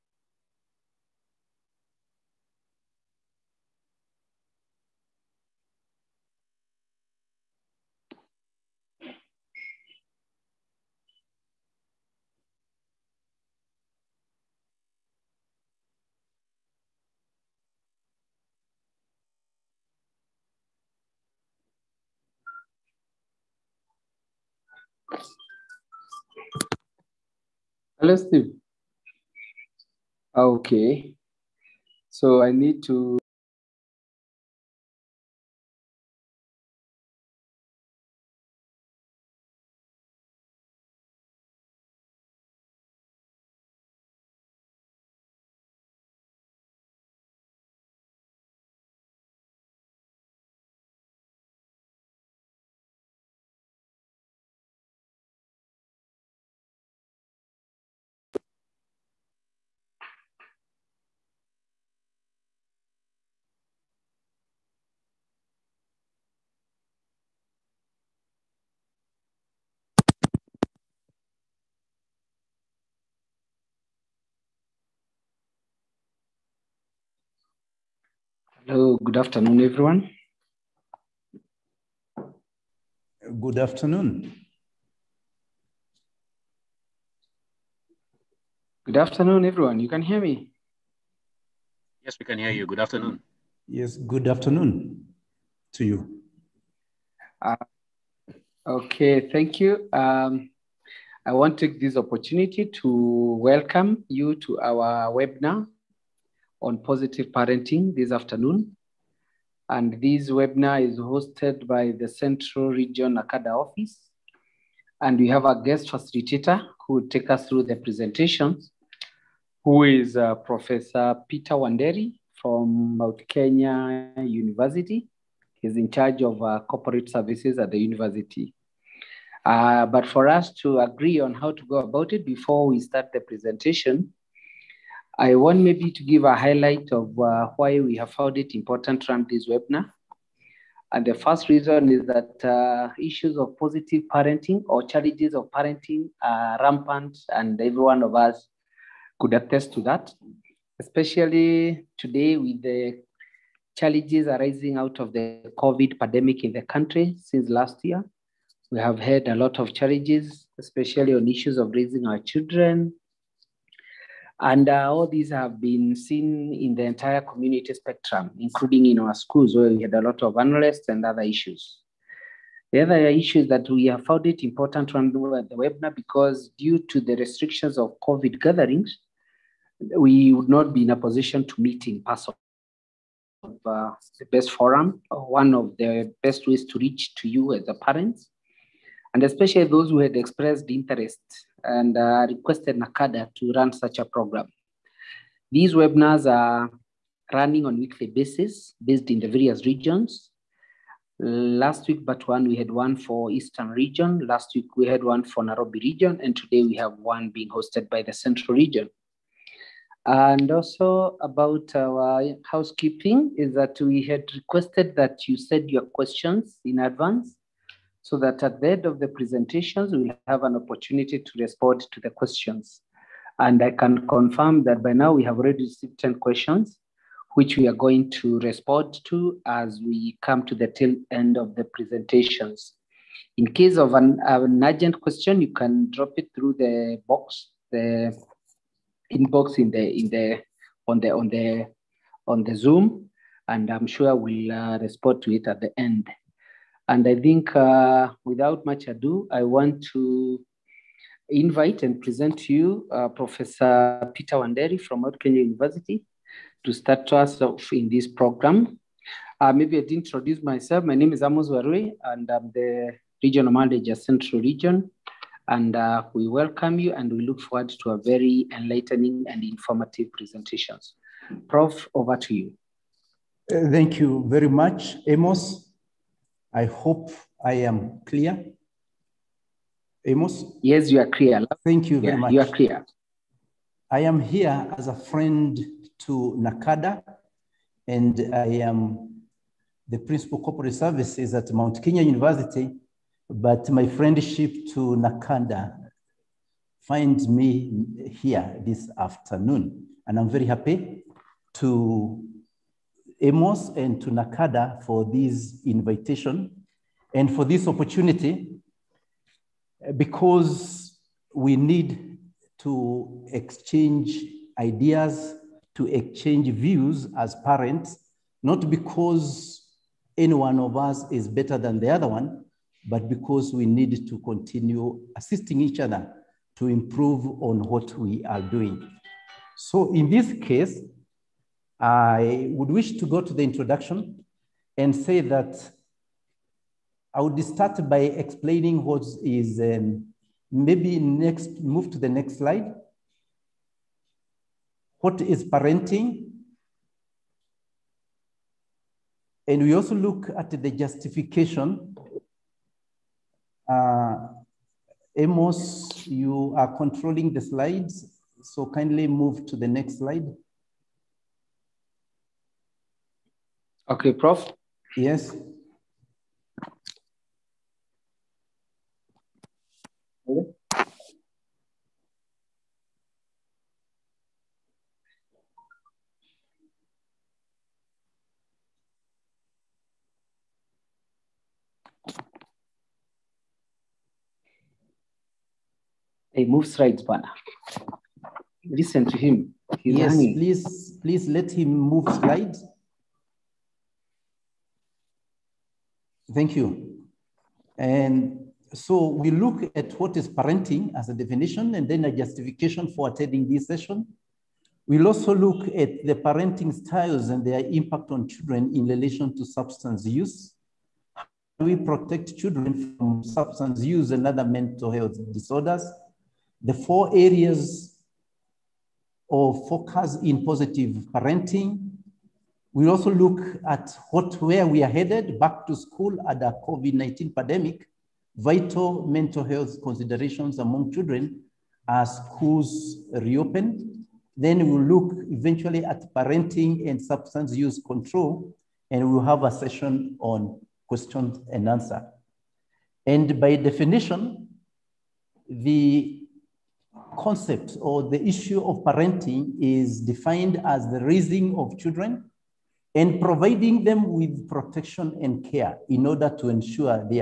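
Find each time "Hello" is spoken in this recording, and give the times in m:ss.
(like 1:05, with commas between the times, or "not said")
0:27, 1:18, 6:10.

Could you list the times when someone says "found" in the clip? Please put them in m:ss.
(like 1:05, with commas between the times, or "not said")
2:18, 2:54.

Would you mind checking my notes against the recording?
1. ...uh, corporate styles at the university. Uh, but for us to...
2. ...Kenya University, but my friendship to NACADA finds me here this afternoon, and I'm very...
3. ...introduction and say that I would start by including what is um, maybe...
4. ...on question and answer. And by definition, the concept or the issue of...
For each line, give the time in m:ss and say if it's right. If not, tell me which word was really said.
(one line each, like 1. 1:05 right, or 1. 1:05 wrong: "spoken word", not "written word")
1. 2:06 wrong: "services", not "styles"
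2. 4:51 right
3. 5:33 wrong: "explaining", not "including"
4. 7:20 right.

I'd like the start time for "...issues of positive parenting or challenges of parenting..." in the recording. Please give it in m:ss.
2:22.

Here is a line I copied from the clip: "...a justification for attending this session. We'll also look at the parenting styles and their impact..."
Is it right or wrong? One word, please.
right.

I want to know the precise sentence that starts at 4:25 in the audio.
And uh, we welcome you and we look forward to a very enlightening and informative presentation.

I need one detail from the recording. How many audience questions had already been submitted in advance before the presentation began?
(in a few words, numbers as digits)
10.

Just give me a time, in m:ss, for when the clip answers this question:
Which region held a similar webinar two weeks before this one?
3:23.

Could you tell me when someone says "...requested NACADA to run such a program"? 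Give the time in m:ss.
3:12.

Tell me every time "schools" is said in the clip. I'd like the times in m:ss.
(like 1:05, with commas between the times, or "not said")
2:49, 7:05, 7:12.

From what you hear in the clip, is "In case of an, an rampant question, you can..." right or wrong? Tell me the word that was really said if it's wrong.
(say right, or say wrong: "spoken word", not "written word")
wrong: "urgent", not "rampant".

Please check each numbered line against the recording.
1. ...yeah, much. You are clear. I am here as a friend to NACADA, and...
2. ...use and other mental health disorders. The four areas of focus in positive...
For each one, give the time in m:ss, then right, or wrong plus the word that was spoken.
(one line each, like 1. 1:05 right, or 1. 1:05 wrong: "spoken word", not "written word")
1. 4:42 right
2. 6:53 right.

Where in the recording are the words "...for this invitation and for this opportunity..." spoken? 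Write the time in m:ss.
5:04.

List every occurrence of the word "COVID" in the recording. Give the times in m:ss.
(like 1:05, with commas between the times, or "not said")
2:35, 2:58, 7:06.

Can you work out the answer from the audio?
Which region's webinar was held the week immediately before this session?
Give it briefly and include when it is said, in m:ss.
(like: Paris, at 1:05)
Nairobi, at 3:25.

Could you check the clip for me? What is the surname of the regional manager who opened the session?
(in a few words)
Warui.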